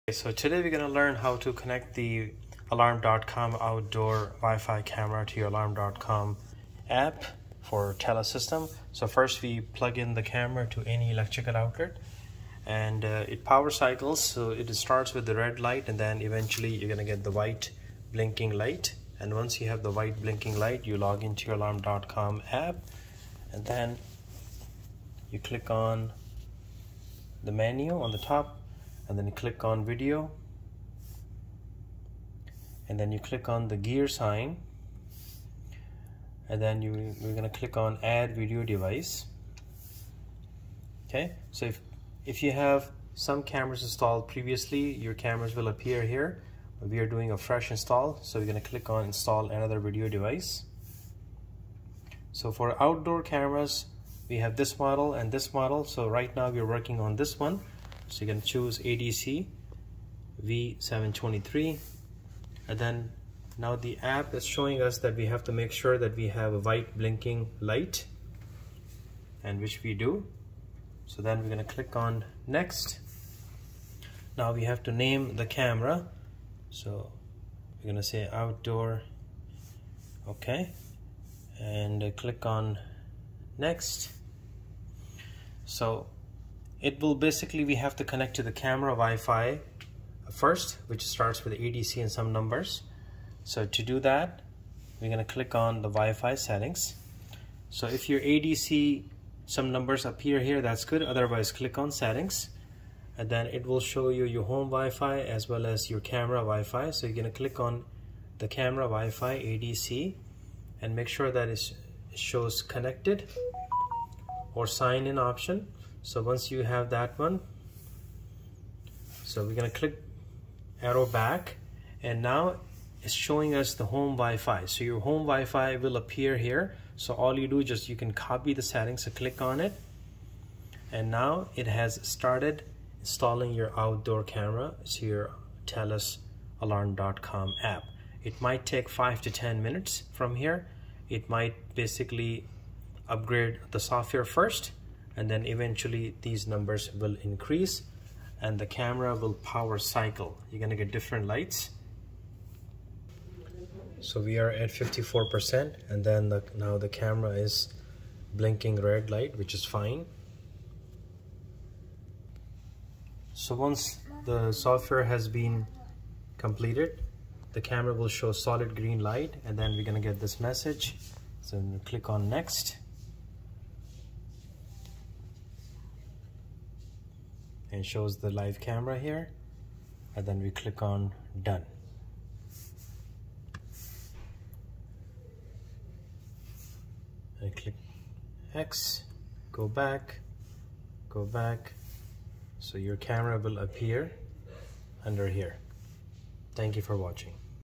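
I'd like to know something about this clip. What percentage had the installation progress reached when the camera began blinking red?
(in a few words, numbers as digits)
54%.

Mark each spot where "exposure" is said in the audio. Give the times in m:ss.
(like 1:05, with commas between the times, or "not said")
not said.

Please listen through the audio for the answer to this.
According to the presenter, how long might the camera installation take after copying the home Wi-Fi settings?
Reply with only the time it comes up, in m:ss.
2:18.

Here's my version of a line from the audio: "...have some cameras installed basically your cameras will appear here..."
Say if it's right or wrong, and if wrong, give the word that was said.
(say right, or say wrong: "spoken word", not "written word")
wrong: "previously", not "basically".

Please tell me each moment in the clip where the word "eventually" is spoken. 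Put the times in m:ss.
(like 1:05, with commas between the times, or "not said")
0:16, 2:25.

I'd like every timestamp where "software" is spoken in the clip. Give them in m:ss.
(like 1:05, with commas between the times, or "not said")
2:23, 2:44.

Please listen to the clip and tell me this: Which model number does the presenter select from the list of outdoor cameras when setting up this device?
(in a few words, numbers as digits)
ADC V723.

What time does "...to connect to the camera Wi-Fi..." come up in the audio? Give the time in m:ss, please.
1:27.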